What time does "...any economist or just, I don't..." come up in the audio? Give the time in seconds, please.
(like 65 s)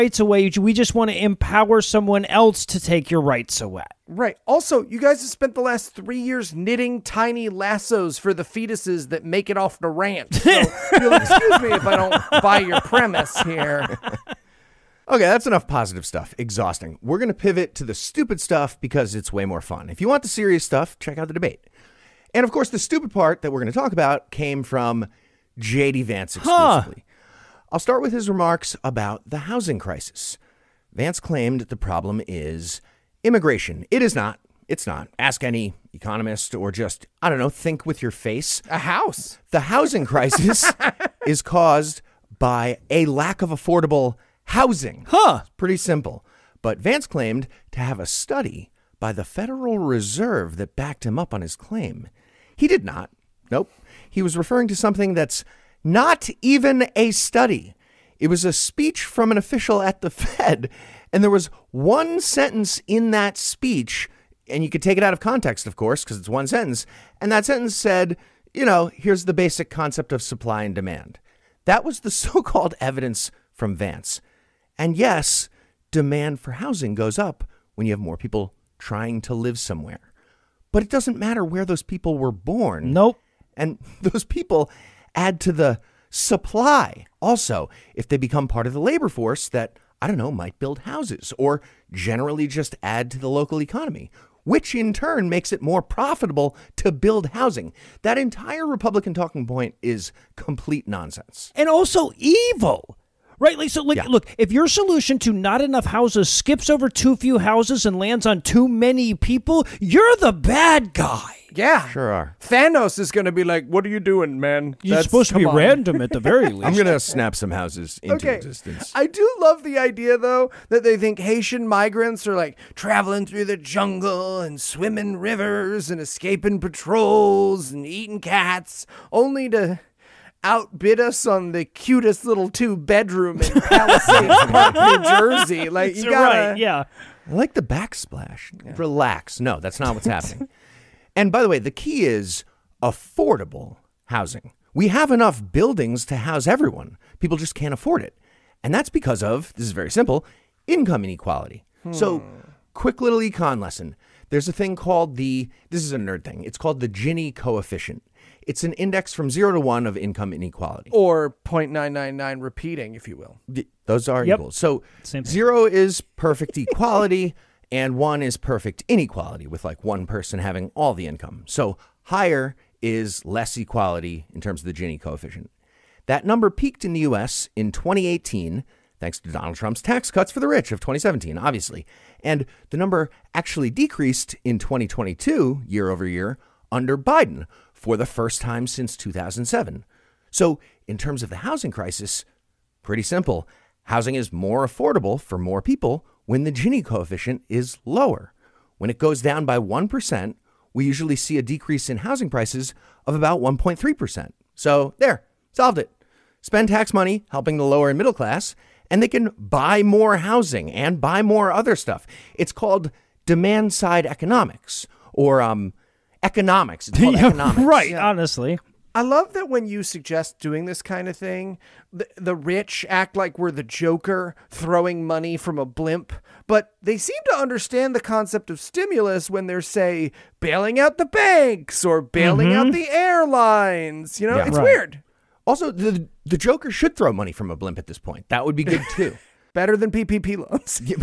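35 s.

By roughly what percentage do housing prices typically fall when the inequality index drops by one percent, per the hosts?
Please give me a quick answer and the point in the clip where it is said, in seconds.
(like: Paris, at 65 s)
1.3%, at 203 s.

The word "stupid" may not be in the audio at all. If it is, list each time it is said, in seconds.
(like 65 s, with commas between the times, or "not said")
17 s, 22 s.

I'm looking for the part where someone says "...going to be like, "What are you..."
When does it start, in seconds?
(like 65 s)
113 s.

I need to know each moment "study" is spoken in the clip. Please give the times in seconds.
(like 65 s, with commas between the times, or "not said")
48 s, 57 s.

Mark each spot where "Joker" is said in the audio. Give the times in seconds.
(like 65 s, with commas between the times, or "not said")
223 s, 236 s.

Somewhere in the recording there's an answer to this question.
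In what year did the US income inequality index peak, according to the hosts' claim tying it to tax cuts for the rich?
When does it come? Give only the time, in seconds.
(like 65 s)
177 s.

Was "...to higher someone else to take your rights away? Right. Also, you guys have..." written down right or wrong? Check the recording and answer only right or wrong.
wrong.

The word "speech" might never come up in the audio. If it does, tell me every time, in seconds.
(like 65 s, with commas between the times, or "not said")
58 s, 63 s.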